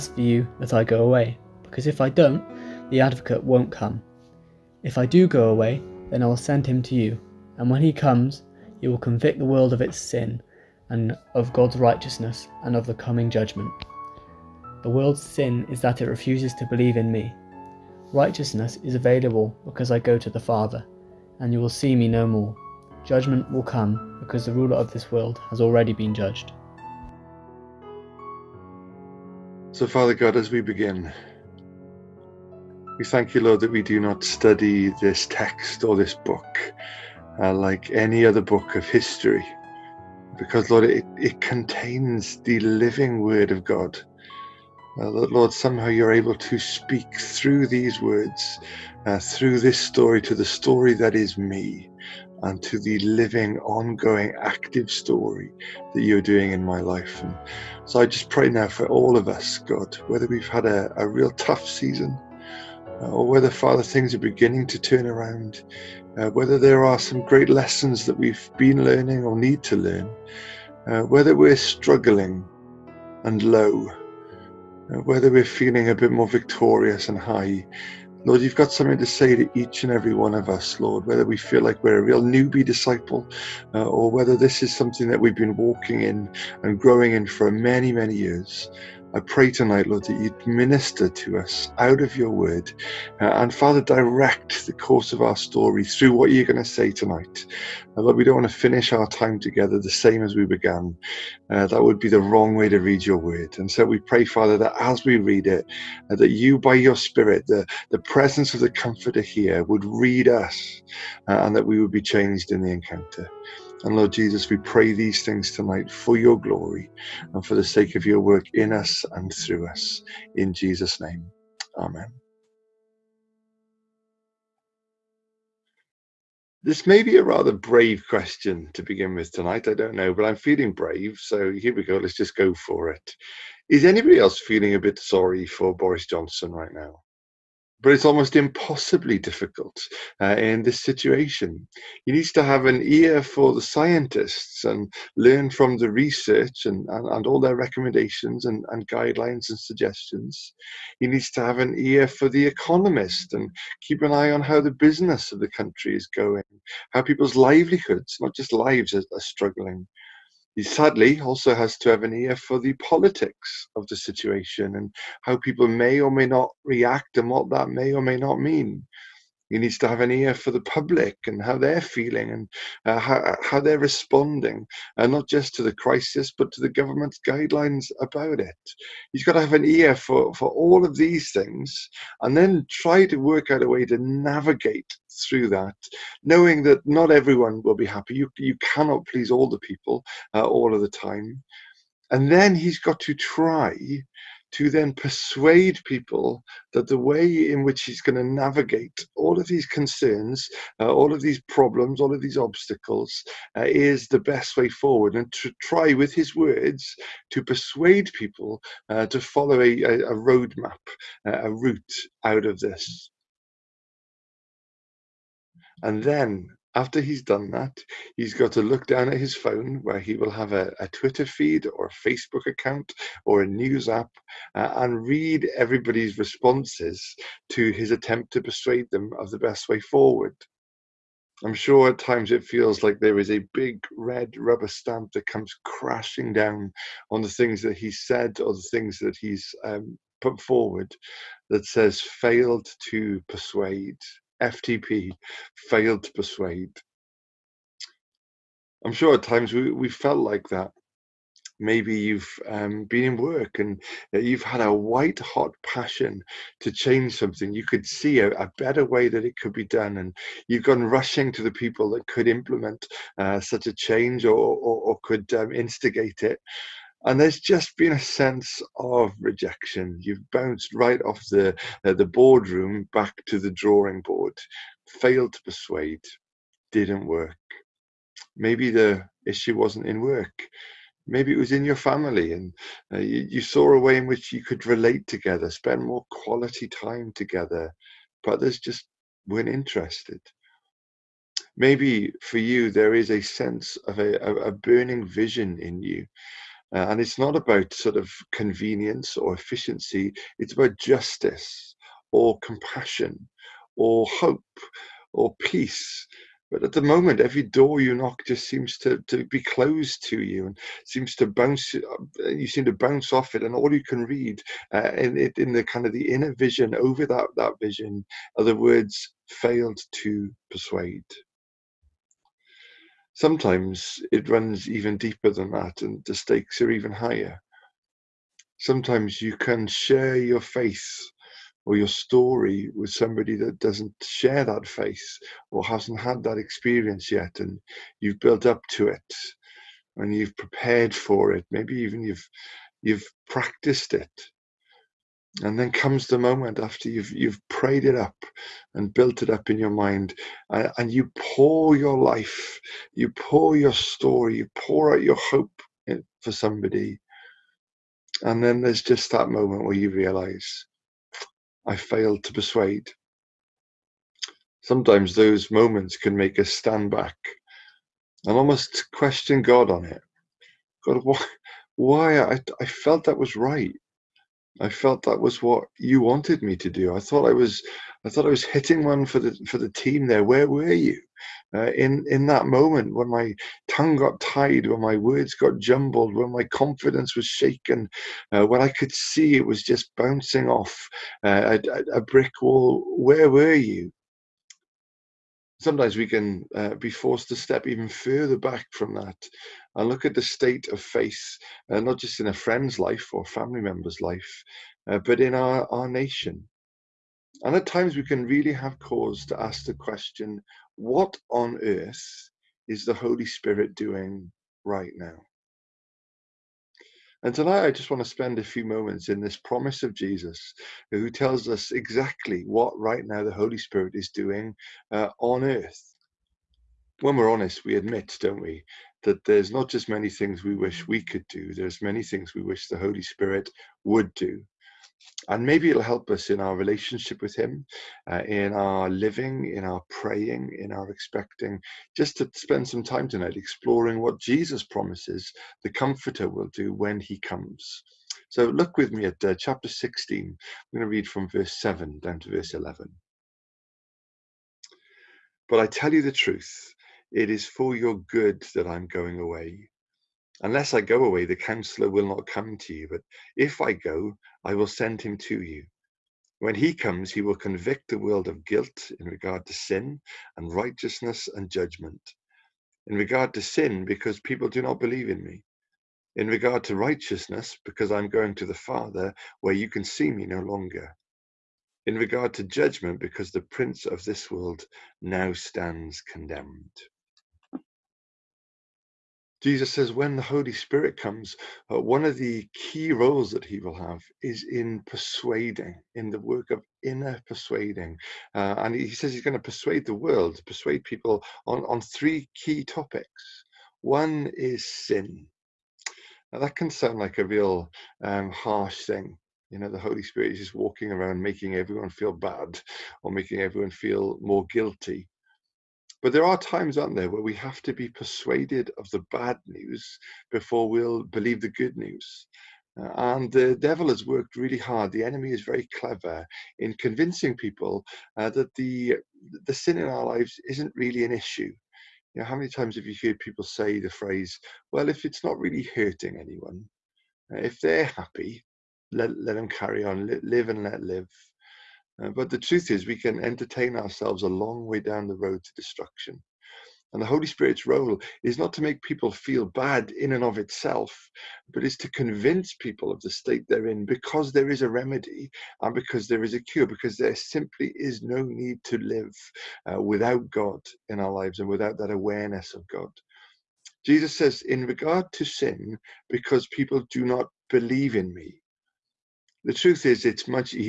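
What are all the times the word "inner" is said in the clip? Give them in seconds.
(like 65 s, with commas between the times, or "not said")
316 s, 496 s.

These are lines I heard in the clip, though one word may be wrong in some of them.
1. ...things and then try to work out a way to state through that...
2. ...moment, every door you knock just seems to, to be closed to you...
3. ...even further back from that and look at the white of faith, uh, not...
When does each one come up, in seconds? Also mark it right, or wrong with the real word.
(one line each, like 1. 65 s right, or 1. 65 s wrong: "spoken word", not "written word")
1. 181 s wrong: "navigate", not "state"
2. 306 s right
3. 397 s wrong: "state", not "white".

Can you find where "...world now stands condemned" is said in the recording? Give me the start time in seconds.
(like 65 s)
484 s.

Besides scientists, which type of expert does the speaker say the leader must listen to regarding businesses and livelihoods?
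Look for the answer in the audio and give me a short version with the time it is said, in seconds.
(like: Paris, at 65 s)
The economist, at 152 s.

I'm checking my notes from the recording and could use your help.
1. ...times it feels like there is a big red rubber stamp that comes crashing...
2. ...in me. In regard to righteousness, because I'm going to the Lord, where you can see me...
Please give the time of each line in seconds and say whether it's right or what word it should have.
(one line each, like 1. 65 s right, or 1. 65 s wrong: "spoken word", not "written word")
1. 231 s right
2. 475 s wrong: "Father", not "Lord".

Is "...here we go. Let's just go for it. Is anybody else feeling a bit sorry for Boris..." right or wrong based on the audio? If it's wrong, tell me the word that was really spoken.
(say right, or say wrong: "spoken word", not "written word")
right.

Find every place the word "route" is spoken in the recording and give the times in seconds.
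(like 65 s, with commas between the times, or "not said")
211 s.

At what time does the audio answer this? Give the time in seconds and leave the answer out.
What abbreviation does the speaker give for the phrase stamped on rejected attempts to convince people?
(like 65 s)
244 s.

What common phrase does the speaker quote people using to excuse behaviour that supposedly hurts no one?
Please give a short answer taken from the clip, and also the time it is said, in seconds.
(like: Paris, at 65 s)
Live and let live, at 540 s.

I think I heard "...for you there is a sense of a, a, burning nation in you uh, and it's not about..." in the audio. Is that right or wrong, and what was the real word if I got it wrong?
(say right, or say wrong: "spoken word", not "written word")
wrong: "vision", not "nation".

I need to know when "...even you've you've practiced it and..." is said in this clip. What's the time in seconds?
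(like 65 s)
341 s.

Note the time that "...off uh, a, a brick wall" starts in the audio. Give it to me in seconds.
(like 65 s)
390 s.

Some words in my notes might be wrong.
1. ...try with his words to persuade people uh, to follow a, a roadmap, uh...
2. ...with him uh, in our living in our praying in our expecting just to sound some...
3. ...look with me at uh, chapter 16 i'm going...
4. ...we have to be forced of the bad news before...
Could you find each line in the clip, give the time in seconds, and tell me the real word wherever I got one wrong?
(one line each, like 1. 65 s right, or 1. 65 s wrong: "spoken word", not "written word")
1. 205 s right
2. 437 s wrong: "spend", not "sound"
3. 448 s right
4. 517 s wrong: "persuaded", not "forced".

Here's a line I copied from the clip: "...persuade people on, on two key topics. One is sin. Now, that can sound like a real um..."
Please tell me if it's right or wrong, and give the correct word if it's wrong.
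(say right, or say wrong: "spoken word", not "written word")
wrong: "three", not "two".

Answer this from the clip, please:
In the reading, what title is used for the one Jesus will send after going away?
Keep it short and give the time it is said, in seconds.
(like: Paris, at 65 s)
The counselor, at 461 s.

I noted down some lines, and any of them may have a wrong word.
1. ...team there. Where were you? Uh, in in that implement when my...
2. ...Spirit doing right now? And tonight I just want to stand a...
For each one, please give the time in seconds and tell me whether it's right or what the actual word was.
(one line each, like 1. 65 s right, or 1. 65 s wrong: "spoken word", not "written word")
1. 379 s wrong: "moment", not "implement"
2. 413 s wrong: "spend", not "stand".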